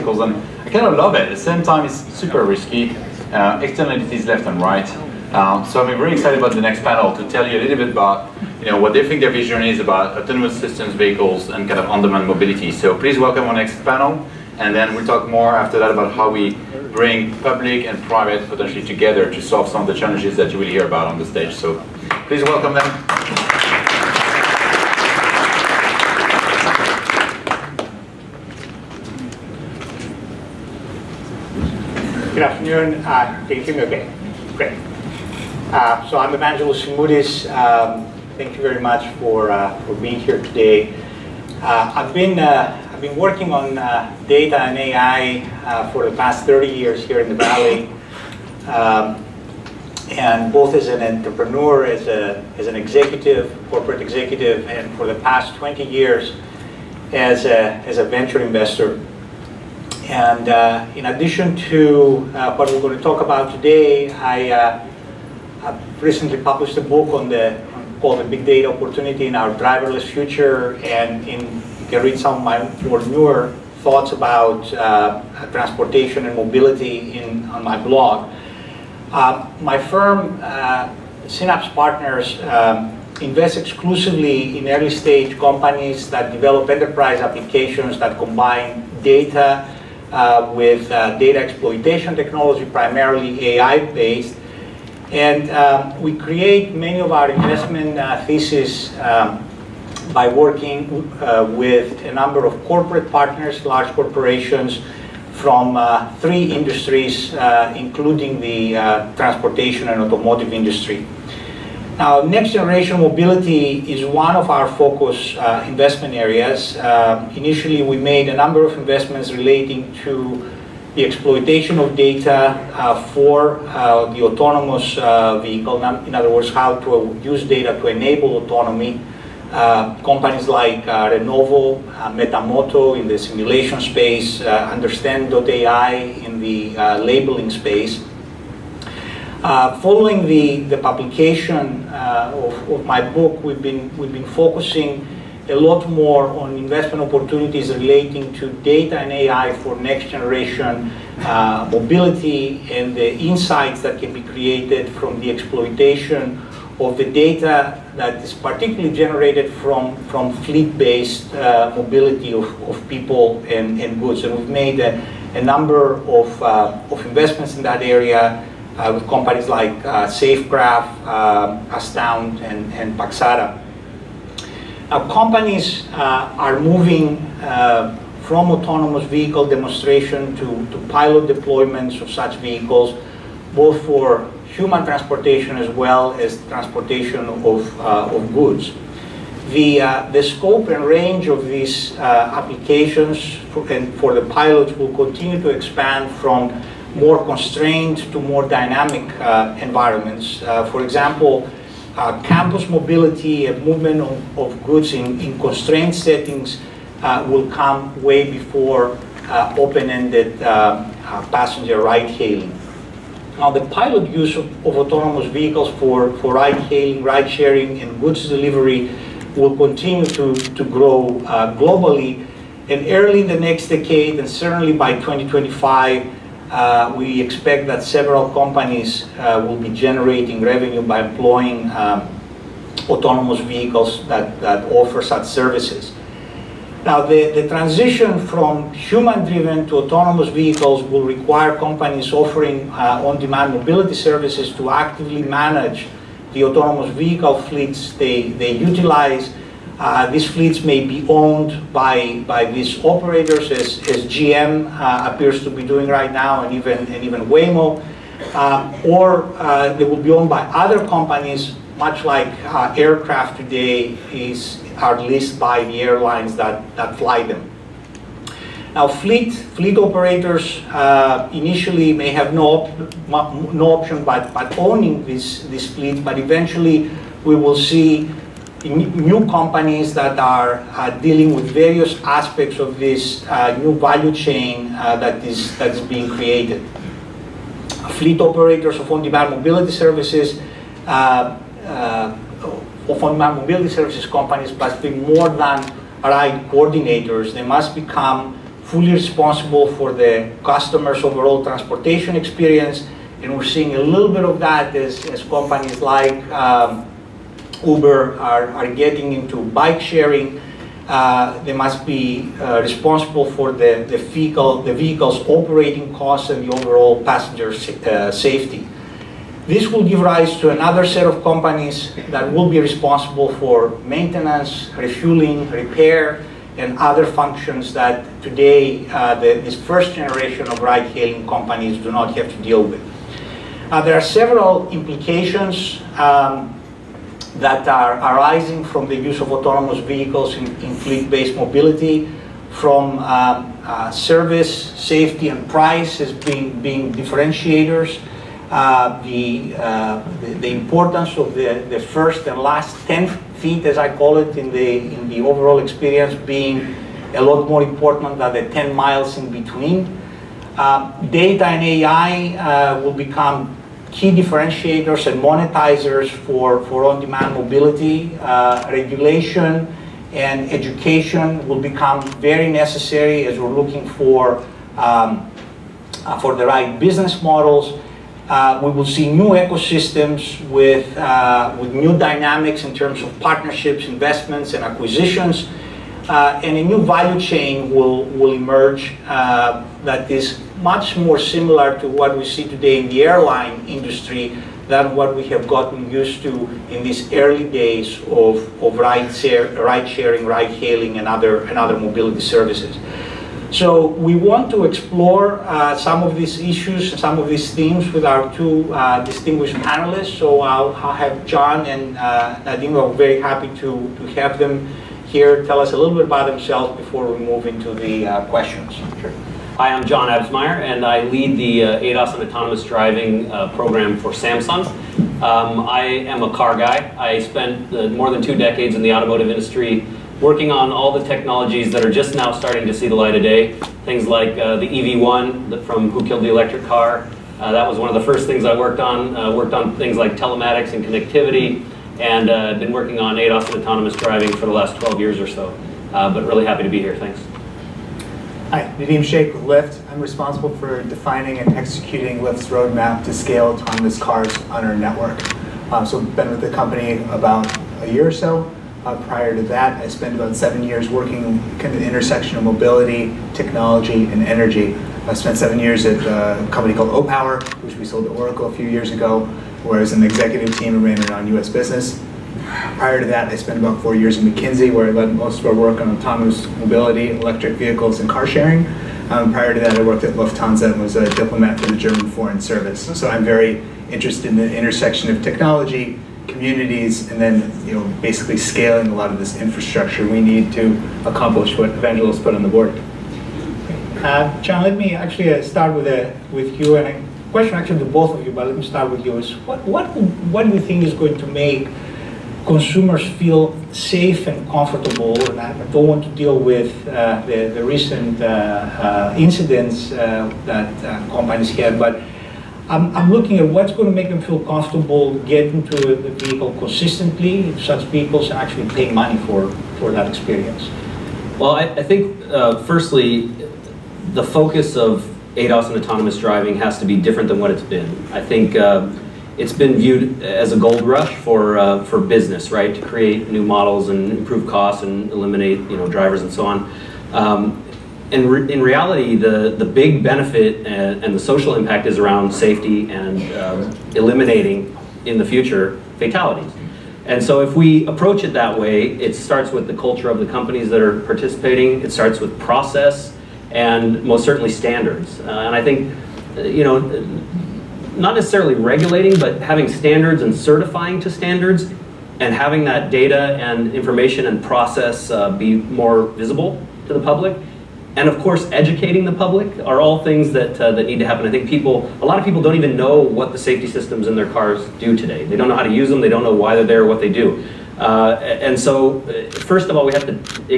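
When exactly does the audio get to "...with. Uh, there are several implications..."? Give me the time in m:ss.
5:32.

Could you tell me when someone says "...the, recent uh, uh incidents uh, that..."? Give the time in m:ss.
8:27.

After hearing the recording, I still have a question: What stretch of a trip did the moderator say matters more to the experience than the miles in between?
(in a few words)
first and last 10 feet.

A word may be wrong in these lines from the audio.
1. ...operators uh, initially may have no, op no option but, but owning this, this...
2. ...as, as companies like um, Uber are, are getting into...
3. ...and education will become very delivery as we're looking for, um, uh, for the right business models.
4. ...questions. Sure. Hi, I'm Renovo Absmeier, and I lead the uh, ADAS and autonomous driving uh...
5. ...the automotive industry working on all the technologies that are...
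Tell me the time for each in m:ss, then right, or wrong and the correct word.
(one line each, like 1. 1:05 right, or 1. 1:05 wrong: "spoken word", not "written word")
1. 4:29 right
2. 5:04 right
3. 6:10 wrong: "necessary", not "delivery"
4. 6:58 wrong: "John", not "Renovo"
5. 7:08 right.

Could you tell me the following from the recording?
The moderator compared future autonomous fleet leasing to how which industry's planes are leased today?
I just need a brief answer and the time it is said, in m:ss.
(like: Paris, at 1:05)
airlines, at 4:25.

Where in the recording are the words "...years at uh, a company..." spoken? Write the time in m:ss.
7:45.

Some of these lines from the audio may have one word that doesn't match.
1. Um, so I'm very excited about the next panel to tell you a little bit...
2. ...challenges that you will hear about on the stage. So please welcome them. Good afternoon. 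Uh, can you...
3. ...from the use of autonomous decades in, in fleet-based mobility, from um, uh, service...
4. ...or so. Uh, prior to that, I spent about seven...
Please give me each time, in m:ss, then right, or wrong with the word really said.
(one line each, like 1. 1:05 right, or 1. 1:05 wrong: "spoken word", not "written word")
1. 0:05 right
2. 0:19 right
3. 5:38 wrong: "vehicles", not "decades"
4. 7:38 right.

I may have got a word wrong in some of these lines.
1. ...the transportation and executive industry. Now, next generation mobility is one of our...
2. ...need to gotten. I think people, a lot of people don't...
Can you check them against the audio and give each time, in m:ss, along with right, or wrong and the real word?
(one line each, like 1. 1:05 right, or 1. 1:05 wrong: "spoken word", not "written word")
1. 1:48 wrong: "automotive", not "executive"
2. 9:30 wrong: "happen", not "gotten".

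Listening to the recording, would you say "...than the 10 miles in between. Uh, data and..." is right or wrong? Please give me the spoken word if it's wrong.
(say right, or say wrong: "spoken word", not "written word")
right.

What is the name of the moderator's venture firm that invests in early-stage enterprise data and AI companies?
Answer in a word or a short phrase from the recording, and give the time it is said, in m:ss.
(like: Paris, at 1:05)
Synapse Partners, at 1:21.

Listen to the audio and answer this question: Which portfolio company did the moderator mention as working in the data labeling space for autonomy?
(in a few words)
Understand.ai.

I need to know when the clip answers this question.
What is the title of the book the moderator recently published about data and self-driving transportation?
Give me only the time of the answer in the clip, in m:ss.
1:08.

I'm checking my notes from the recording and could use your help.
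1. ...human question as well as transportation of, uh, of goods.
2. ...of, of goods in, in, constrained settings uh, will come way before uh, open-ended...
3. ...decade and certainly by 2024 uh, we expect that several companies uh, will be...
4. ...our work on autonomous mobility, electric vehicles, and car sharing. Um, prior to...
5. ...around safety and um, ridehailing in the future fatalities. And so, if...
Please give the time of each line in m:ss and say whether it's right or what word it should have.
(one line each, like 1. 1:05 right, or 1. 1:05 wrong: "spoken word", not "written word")
1. 3:04 wrong: "transportation", not "question"
2. 3:24 right
3. 3:43 wrong: "2025", not "2024"
4. 7:55 right
5. 9:01 wrong: "eliminating", not "ridehailing".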